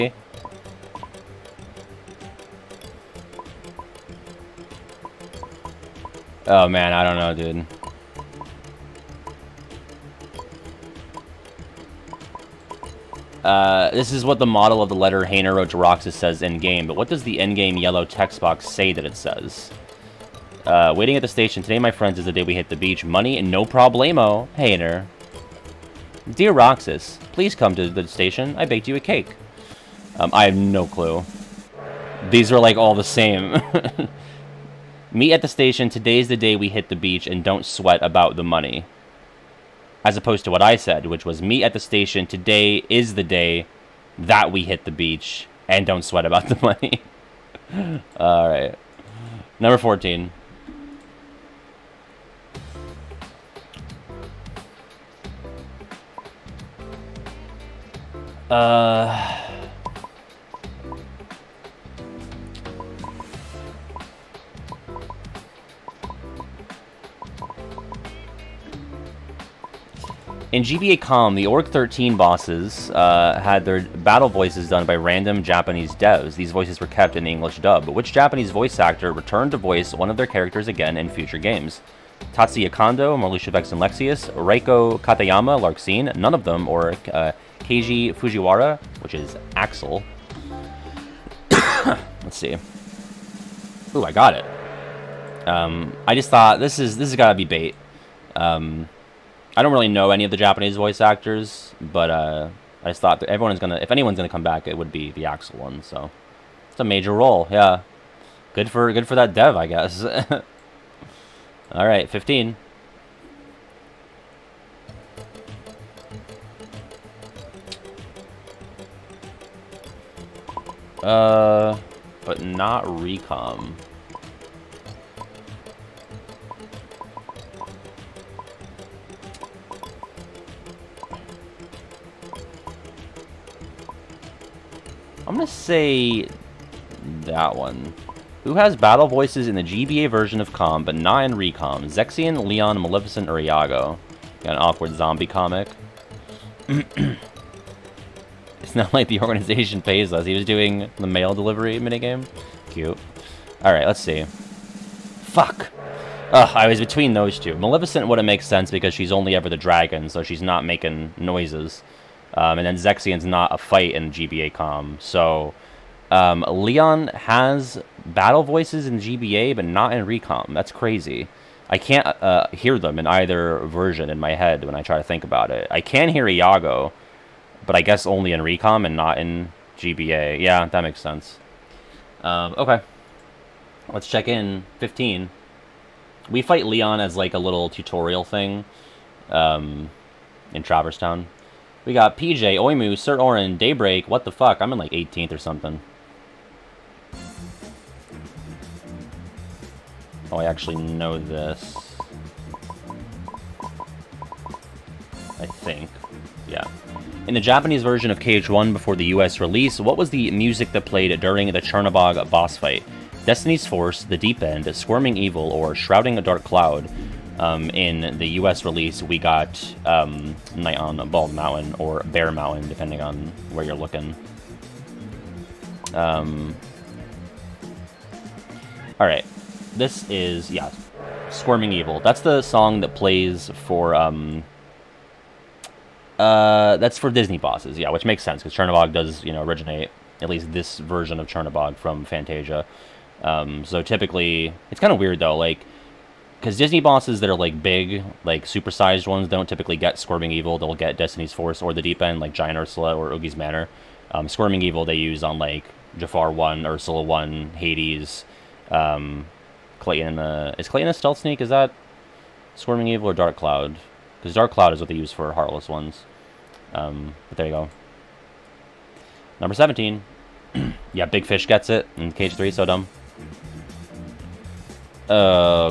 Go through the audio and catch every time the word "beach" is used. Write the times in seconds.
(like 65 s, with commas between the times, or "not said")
22 s, 36 s, 44 s.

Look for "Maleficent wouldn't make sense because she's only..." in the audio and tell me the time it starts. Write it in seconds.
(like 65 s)
157 s.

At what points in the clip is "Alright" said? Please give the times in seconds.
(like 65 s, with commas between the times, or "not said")
153 s, 229 s.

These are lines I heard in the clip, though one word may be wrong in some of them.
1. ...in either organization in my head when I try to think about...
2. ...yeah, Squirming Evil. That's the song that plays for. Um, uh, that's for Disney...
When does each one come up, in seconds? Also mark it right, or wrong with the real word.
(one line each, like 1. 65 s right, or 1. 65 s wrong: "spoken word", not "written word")
1. 172 s wrong: "version", not "organization"
2. 230 s right.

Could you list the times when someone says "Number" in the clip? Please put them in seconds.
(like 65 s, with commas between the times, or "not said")
49 s, 269 s.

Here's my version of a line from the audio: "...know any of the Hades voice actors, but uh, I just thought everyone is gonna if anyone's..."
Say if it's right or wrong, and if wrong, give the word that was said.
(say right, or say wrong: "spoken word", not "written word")
wrong: "Japanese", not "Hades".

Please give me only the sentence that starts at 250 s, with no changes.
They'll get Destiny's Force or the Deep End, like Giant Ursula or Oogie's Manor.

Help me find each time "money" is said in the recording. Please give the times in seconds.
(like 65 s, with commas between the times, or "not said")
23 s, 38 s, 46 s.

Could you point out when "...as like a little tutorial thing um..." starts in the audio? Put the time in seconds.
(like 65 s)
187 s.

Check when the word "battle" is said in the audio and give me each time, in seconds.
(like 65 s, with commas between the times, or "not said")
73 s, 138 s, 168 s.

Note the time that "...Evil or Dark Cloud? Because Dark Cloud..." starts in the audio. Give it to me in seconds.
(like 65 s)
262 s.